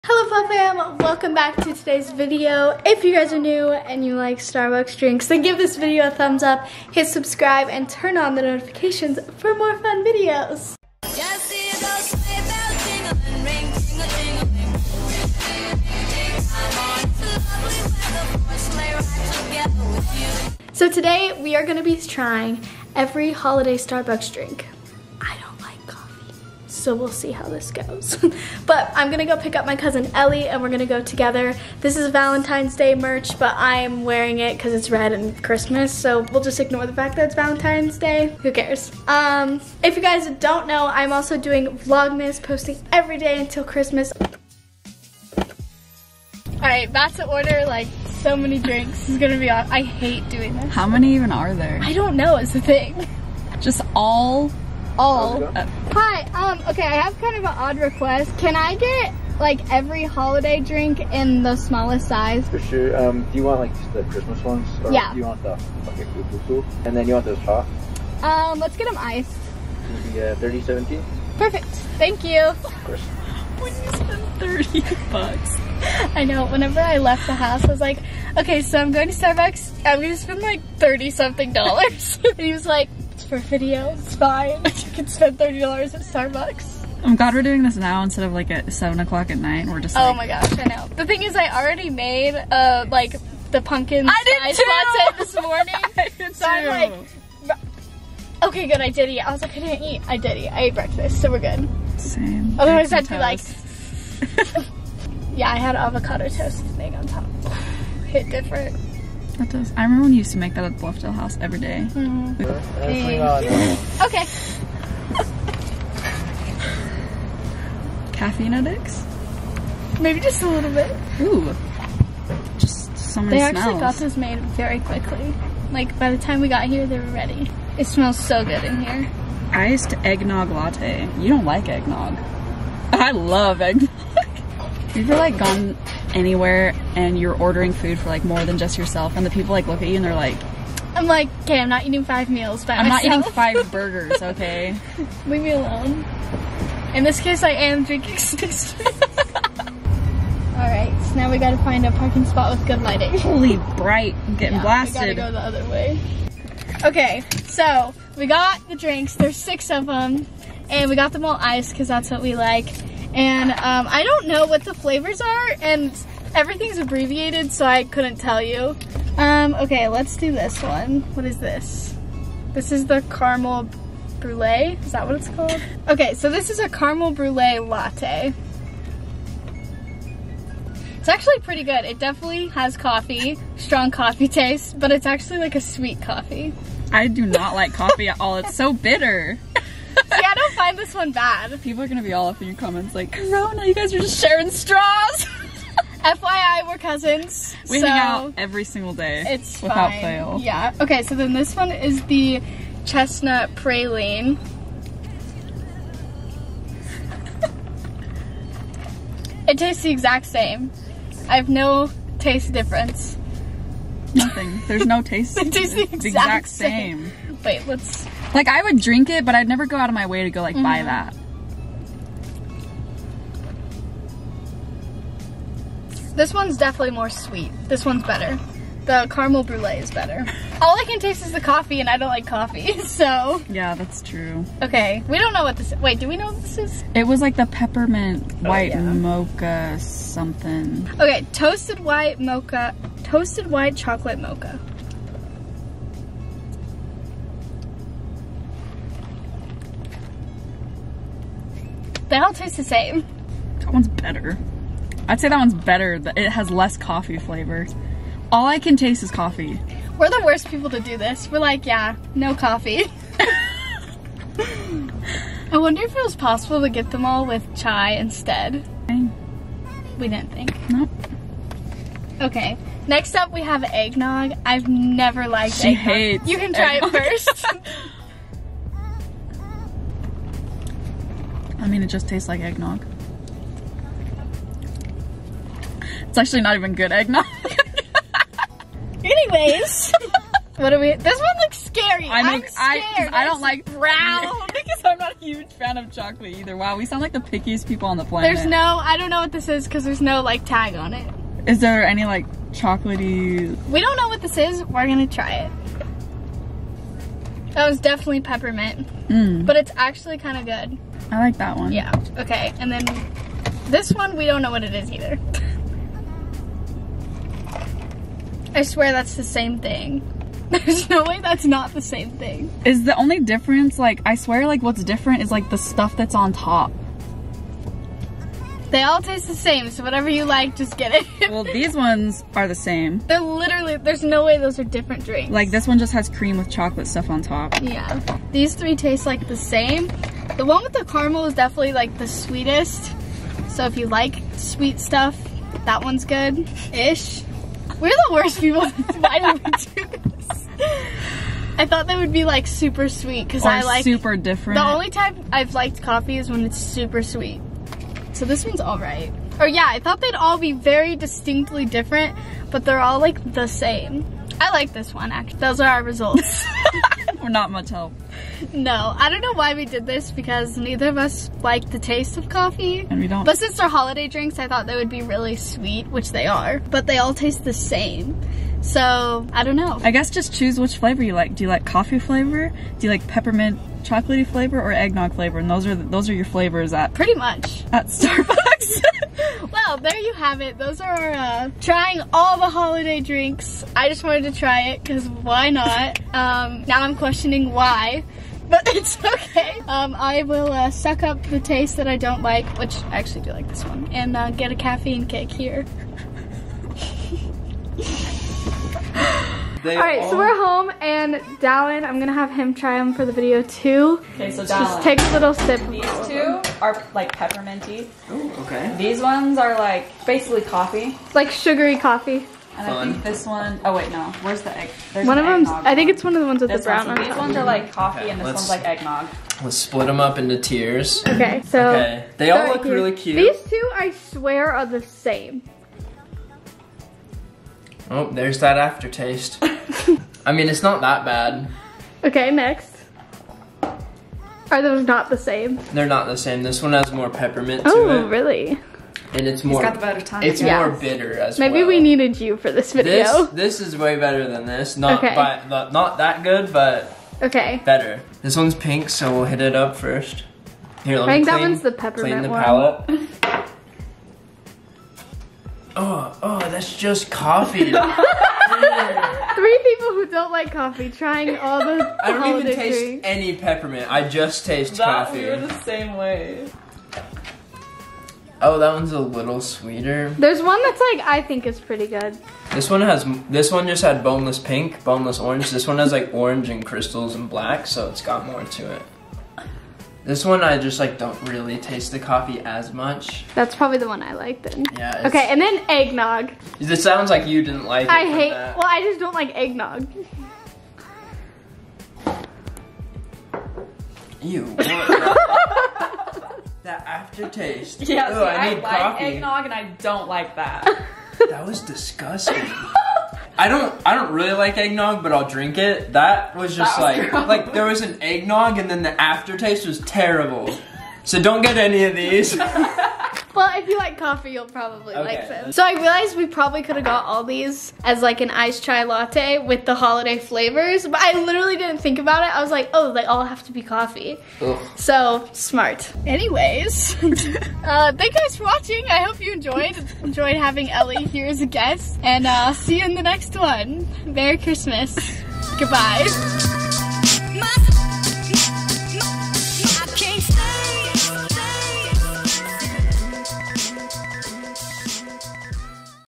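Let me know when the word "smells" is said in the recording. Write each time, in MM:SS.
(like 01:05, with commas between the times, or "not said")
02:03, 02:07.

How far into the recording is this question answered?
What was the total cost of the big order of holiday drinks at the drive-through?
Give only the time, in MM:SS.
01:10.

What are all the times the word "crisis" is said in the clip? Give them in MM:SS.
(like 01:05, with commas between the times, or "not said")
not said.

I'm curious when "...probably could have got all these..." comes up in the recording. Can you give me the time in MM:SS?
08:46.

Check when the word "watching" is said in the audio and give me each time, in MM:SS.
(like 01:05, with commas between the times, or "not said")
08:58.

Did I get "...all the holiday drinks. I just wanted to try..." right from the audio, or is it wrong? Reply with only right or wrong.
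right.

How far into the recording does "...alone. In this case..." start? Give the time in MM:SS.
02:25.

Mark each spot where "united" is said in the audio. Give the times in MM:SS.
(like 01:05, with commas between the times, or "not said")
not said.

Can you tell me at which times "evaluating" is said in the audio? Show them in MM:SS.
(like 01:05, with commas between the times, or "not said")
not said.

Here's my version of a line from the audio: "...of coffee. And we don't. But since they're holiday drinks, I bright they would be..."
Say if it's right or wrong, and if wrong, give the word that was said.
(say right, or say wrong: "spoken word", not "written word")
wrong: "thought", not "bright".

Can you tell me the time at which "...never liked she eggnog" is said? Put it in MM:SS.
04:34.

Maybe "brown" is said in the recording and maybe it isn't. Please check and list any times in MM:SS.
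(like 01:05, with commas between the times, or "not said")
04:53, 07:06.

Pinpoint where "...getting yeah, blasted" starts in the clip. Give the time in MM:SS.
02:34.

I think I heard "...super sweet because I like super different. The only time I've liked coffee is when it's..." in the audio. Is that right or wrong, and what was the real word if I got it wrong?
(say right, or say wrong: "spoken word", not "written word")
right.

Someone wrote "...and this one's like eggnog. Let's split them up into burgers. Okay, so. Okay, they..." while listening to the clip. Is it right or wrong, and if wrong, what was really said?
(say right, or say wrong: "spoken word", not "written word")
wrong: "tiers", not "burgers".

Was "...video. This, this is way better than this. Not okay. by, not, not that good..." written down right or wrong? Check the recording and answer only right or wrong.
right.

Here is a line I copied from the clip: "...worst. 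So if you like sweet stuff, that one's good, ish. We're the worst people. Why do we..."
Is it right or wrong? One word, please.
wrong.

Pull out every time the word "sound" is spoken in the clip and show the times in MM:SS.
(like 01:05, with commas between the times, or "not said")
04:56, 08:16.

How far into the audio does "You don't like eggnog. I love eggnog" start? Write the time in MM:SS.
02:11.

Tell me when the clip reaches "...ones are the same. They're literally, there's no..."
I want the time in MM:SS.
05:31.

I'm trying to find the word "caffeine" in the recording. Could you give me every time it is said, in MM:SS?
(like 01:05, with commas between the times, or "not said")
01:58, 06:44.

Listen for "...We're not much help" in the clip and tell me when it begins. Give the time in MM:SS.
06:07.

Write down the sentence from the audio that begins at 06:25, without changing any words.
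And those are those are your flavors at pretty much at Starbucks.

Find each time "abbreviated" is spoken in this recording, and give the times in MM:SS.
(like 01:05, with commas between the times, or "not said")
02:46.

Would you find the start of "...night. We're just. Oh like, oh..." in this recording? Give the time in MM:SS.
01:29.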